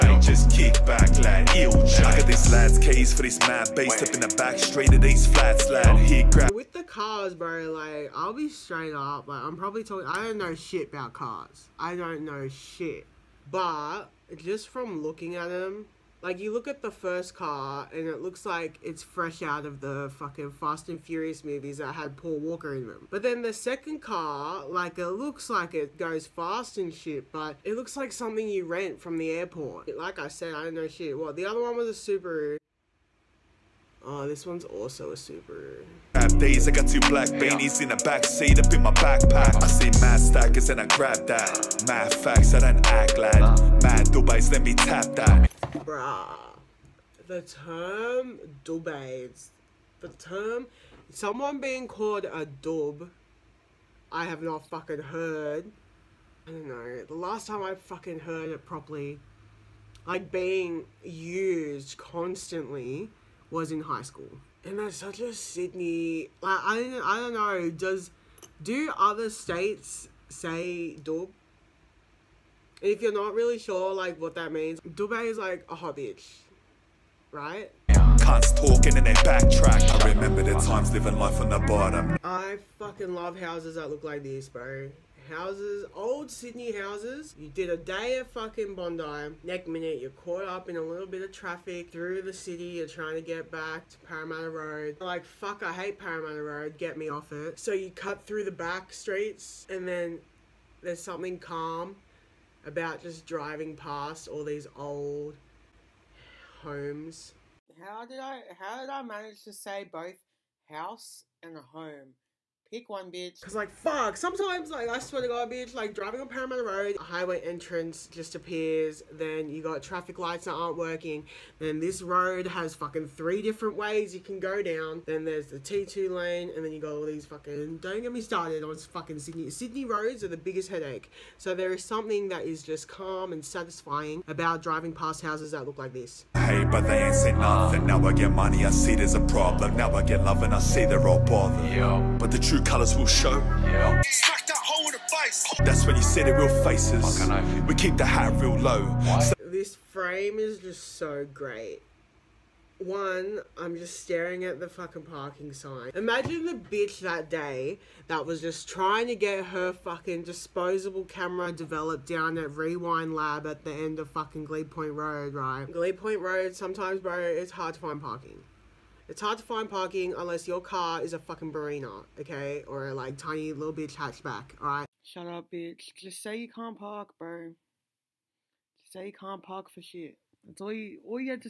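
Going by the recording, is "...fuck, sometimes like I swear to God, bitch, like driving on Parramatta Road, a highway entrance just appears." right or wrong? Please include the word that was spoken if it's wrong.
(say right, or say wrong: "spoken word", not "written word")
right.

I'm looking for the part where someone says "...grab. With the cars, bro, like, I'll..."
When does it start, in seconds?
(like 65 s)
6 s.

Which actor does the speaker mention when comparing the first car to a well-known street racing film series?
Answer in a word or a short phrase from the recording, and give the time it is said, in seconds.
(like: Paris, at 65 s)
Paul Walker, at 22 s.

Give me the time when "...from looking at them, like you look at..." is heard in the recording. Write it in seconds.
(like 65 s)
14 s.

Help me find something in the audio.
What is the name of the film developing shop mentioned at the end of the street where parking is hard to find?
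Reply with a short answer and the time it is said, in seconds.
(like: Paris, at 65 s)
Rewind Lab, at 162 s.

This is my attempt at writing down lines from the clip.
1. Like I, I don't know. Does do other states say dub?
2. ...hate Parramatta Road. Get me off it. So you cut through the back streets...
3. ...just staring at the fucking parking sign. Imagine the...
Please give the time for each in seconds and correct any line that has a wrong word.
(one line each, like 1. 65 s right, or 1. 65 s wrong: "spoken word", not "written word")
1. 66 s right
2. 95 s right
3. 153 s right.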